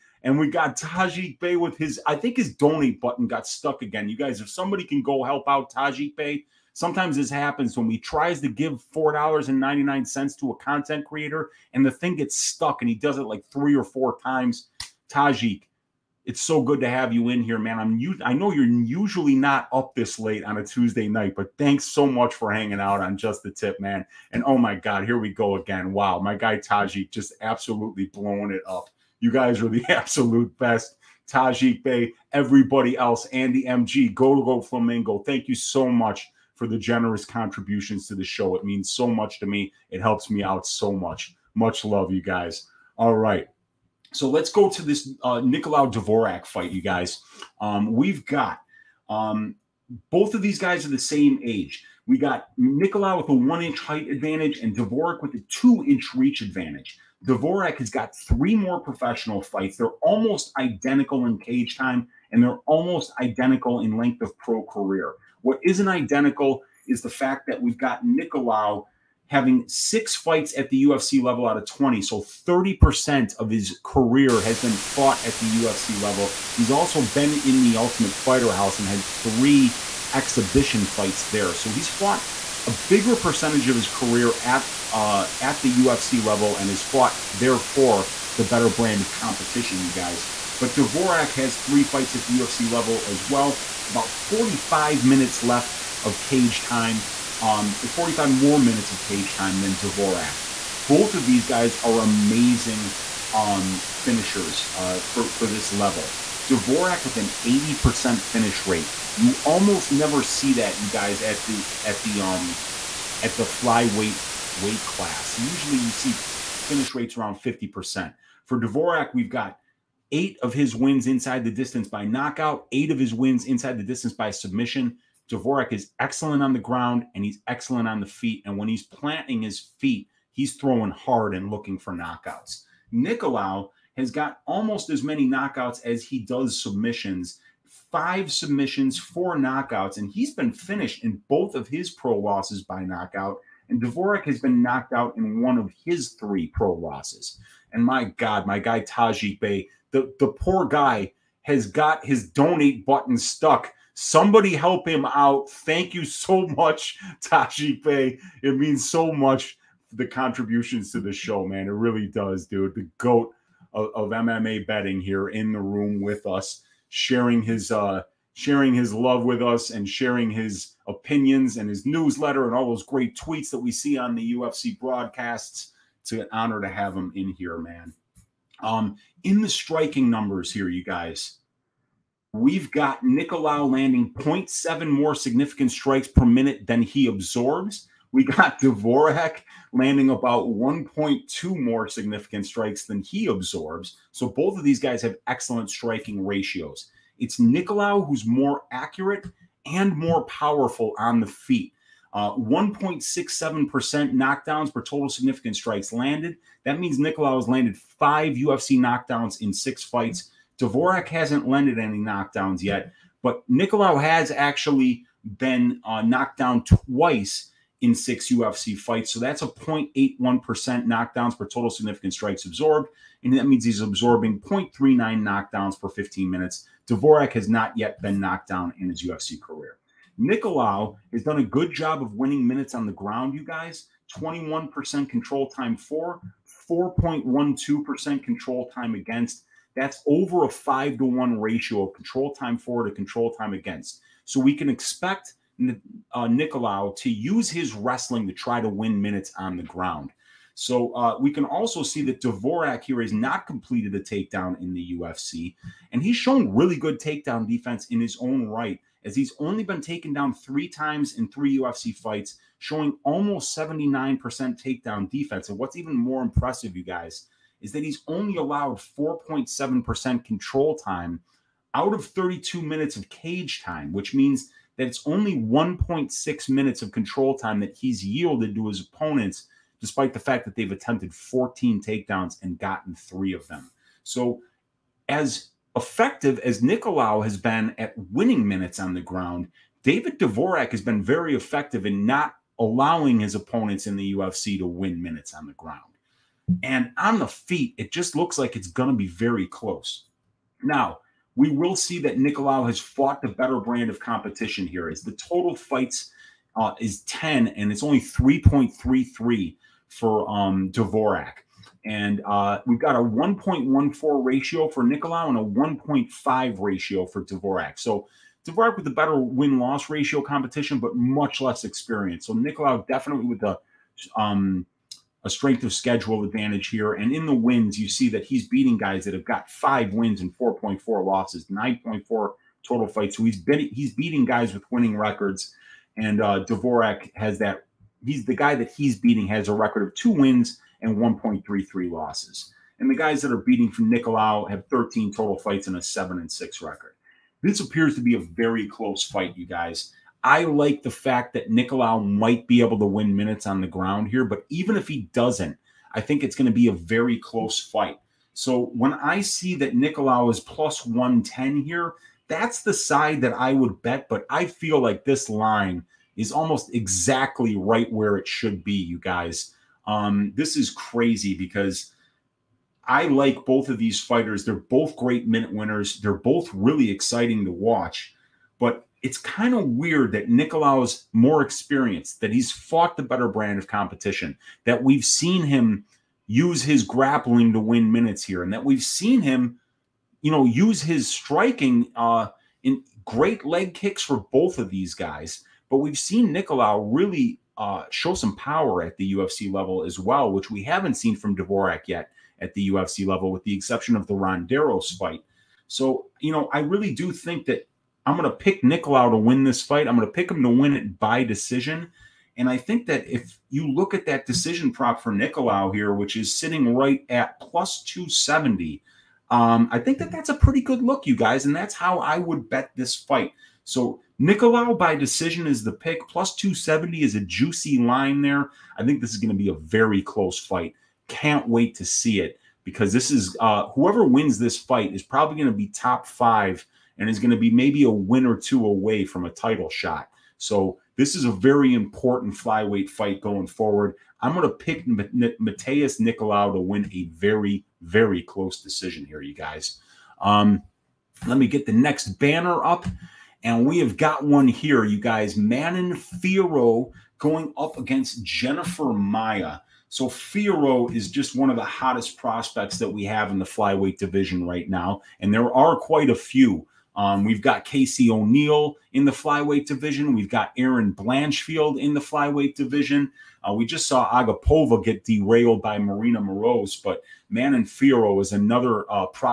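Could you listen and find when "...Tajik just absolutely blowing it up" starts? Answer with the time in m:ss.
0:26.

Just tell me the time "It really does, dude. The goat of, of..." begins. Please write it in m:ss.
2:41.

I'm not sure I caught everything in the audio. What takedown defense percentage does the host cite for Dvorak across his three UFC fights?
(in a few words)
79%.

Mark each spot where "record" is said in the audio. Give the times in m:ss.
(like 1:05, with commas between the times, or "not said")
5:34, 5:39, 5:46.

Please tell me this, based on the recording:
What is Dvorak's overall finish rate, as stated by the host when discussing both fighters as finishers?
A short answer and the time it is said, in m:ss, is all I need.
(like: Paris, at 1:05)
80%, at 1:47.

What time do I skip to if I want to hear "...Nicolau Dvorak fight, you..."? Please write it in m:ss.
0:45.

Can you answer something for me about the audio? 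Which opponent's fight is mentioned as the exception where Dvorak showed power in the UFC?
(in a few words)
Ronderos.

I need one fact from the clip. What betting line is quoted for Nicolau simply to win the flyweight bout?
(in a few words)
+110.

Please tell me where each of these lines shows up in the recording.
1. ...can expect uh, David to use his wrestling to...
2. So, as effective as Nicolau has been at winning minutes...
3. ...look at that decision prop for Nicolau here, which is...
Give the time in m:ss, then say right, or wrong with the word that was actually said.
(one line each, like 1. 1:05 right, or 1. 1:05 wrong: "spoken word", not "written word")
1. 4:04 wrong: "Nicolau", not "David"
2. 4:44 right
3. 6:53 right.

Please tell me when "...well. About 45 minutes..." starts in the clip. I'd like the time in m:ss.
1:33.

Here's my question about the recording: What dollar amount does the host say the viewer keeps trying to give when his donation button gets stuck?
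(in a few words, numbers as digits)
$4.99.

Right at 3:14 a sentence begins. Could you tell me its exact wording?
So both of these guys have excellent striking ratios.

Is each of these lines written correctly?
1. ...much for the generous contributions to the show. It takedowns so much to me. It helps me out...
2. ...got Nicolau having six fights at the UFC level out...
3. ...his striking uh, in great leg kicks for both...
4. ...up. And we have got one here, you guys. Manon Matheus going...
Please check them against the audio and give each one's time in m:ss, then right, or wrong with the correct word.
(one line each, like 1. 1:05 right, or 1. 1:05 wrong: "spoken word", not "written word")
1. 0:35 wrong: "means", not "takedowns"
2. 1:07 right
3. 6:30 right
4. 7:32 wrong: "Fiorot", not "Matheus".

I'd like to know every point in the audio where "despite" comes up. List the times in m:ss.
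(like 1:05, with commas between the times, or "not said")
4:39.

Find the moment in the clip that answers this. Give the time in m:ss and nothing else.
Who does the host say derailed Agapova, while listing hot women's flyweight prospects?
7:55.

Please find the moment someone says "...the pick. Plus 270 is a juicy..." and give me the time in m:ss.
7:05.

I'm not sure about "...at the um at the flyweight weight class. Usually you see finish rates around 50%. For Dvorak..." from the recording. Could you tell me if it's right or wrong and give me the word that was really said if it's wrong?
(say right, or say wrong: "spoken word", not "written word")
right.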